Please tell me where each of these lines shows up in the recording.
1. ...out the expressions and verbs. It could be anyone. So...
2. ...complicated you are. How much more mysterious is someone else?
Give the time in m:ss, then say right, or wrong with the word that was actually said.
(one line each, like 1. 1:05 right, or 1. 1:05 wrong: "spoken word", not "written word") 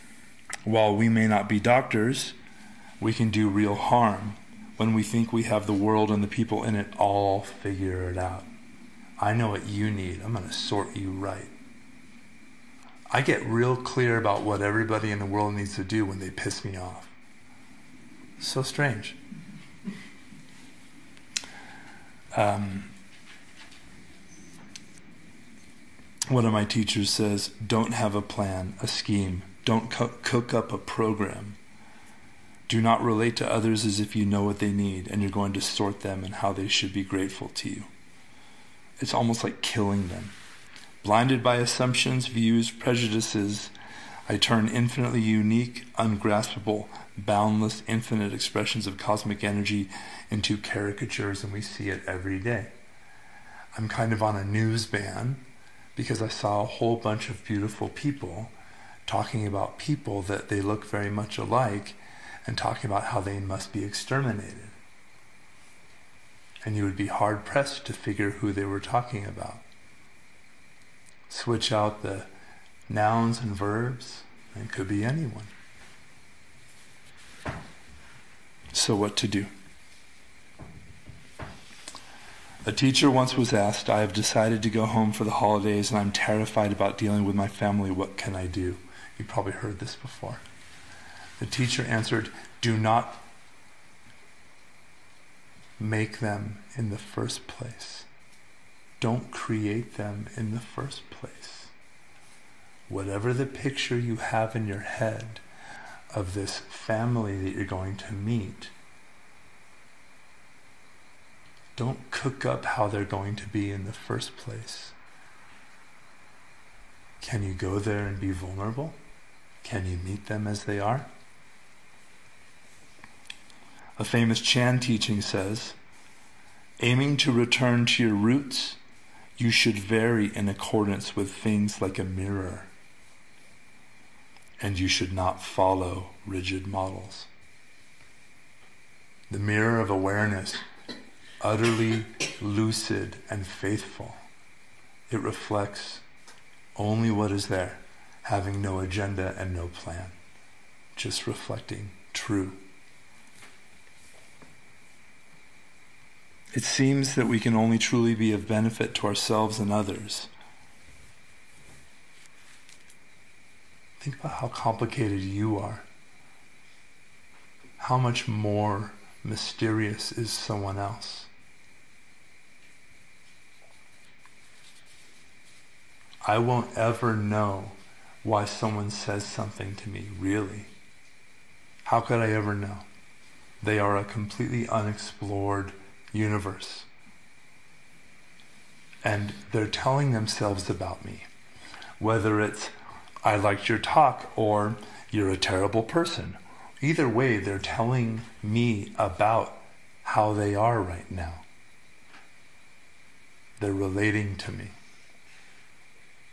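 1. 1:11 wrong: "nouns", not "expressions"
2. 2:44 right.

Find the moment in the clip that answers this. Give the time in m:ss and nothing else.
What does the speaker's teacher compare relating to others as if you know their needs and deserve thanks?
0:39.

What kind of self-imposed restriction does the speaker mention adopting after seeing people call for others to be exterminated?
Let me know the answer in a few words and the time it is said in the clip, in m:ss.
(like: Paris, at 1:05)
News ban, at 0:54.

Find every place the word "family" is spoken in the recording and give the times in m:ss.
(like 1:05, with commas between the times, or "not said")
1:27, 1:46.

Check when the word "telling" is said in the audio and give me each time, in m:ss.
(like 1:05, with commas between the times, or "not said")
3:09, 3:17.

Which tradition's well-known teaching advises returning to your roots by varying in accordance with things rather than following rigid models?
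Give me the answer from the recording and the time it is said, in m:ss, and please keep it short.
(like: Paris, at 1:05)
Chan, at 2:04.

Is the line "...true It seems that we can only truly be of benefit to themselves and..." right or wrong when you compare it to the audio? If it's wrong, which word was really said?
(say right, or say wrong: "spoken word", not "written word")
wrong: "ourselves", not "themselves".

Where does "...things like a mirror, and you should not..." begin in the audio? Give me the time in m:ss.
2:11.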